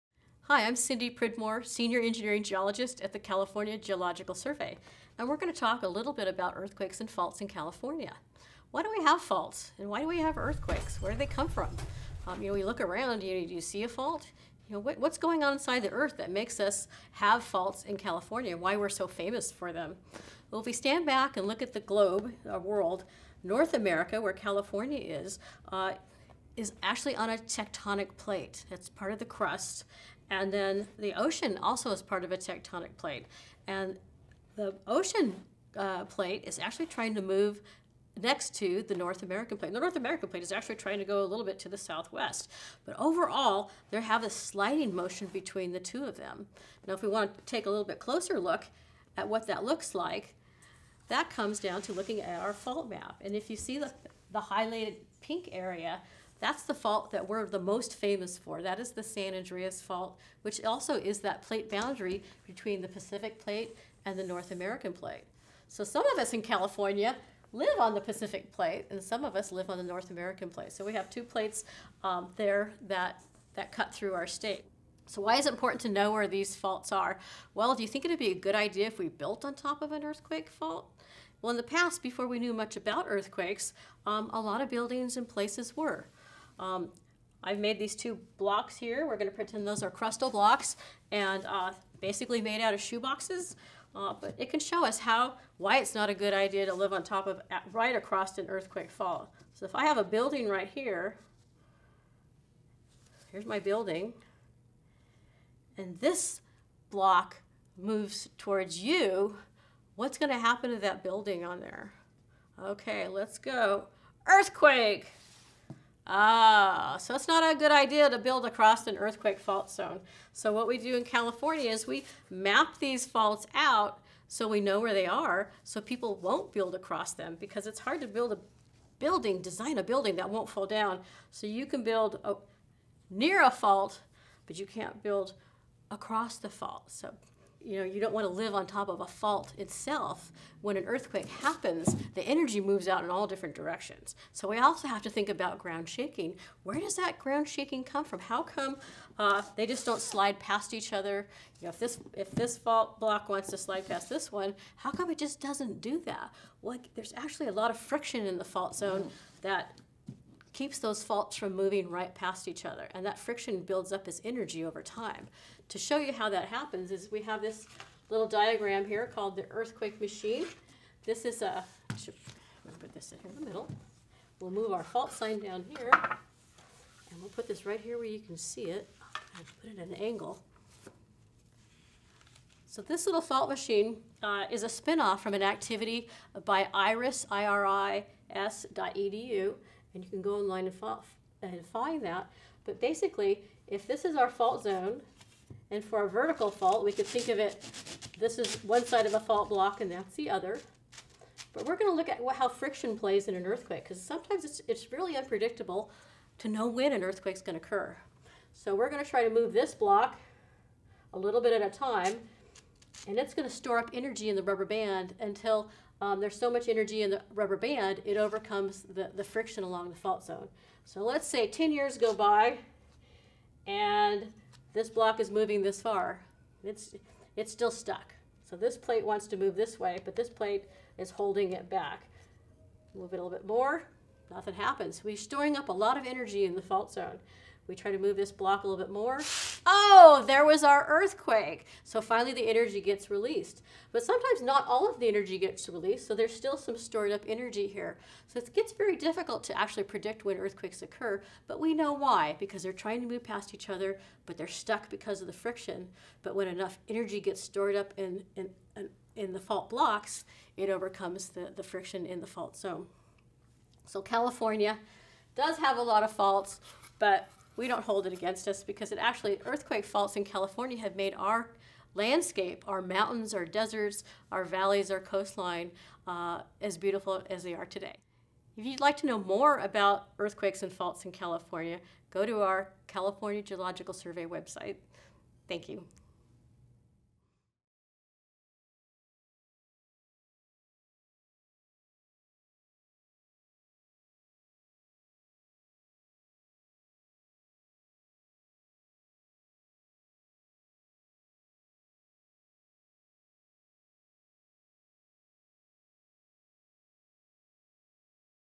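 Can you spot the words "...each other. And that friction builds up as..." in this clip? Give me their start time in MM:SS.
02:42.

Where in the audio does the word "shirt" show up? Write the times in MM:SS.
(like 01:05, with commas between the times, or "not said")
not said.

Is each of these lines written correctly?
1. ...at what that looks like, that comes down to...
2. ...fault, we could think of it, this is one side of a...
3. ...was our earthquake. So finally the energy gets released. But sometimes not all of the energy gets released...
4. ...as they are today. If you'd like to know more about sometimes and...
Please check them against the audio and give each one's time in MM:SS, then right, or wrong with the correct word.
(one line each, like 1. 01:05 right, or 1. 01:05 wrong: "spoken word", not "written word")
1. 00:49 right
2. 03:16 right
3. 04:00 right
4. 04:37 wrong: "earthquakes", not "sometimes".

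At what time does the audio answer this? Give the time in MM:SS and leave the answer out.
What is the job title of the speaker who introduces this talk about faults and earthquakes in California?
00:01.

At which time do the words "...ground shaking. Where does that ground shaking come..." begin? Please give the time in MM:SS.
02:25.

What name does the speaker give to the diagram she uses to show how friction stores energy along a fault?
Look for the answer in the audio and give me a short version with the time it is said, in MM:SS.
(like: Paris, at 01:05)
The earthquake machine, at 02:49.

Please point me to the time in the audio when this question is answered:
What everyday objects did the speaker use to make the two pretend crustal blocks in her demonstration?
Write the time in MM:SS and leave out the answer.
01:32.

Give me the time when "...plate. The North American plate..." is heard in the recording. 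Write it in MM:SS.
00:39.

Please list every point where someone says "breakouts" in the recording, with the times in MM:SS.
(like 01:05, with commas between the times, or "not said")
not said.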